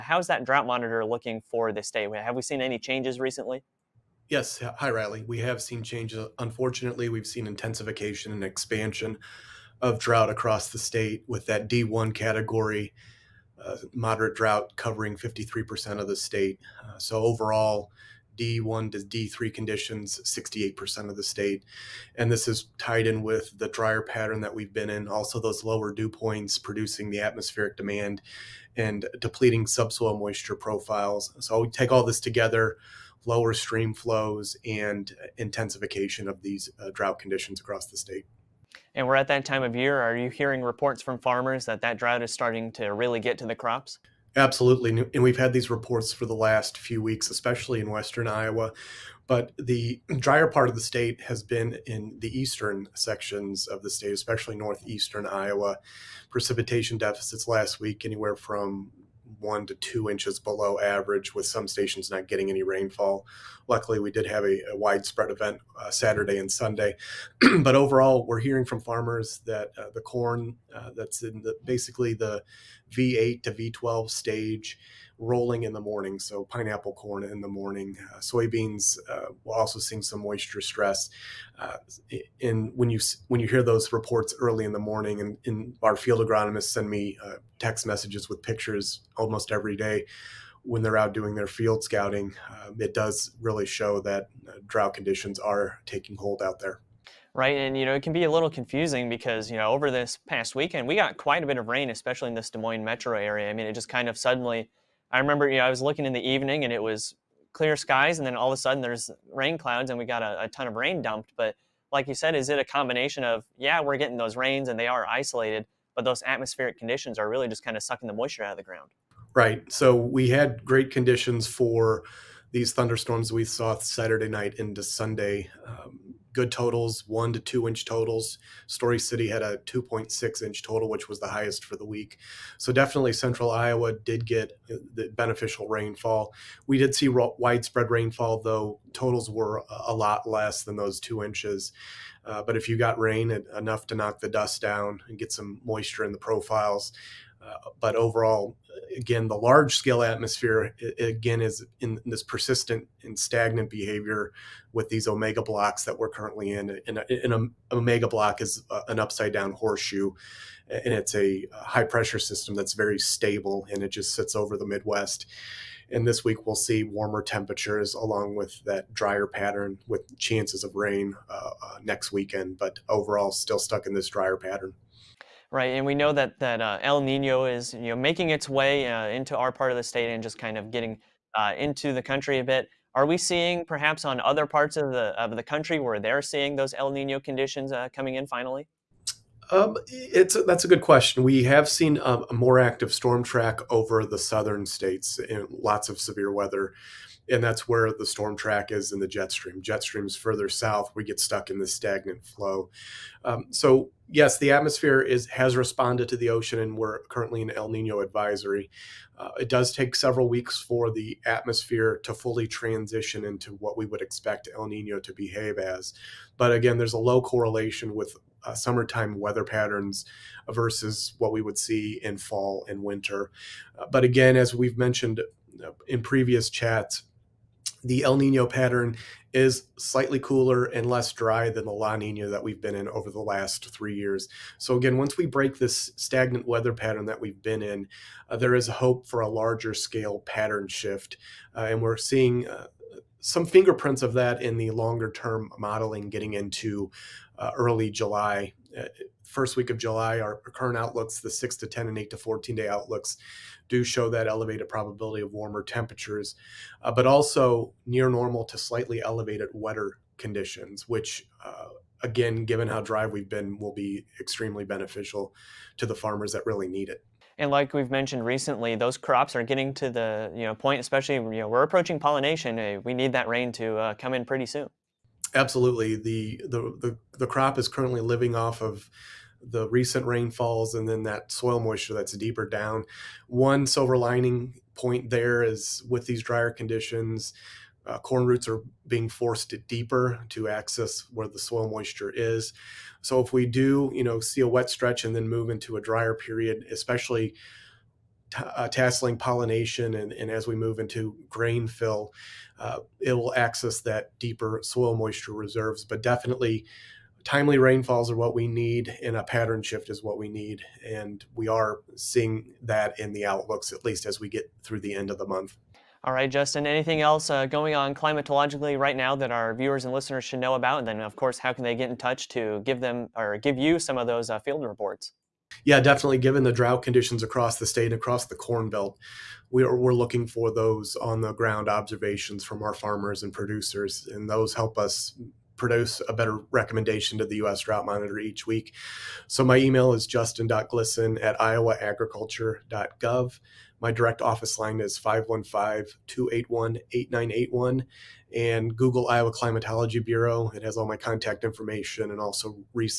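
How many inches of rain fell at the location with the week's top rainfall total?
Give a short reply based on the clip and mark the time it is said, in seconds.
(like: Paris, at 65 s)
2.6 inches, at 129 s.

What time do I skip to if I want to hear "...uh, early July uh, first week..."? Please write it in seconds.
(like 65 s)
247 s.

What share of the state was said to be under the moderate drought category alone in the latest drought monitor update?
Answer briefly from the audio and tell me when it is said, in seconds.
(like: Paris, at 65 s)
53%, at 15 s.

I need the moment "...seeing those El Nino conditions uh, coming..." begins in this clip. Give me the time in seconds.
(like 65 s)
186 s.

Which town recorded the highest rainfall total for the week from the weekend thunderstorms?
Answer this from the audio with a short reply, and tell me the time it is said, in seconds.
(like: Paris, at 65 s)
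Story City, at 128 s.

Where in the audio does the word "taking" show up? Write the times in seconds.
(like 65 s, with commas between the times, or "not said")
95 s.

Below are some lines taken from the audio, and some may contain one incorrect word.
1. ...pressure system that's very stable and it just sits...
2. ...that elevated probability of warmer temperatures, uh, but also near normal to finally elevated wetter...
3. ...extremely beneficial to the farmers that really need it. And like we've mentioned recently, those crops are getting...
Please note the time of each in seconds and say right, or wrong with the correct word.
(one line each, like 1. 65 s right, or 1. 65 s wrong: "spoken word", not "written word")
1. 161 s right
2. 254 s wrong: "slightly", not "finally"
3. 264 s right.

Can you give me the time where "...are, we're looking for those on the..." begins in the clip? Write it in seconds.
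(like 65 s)
329 s.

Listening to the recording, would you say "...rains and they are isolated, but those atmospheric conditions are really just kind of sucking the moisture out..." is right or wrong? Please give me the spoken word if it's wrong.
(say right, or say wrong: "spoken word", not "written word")
right.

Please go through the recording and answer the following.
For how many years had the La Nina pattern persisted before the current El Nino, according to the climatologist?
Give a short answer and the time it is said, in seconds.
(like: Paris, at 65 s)
3 years, at 233 s.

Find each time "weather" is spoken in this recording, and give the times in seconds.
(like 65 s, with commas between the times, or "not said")
196 s, 219 s, 236 s.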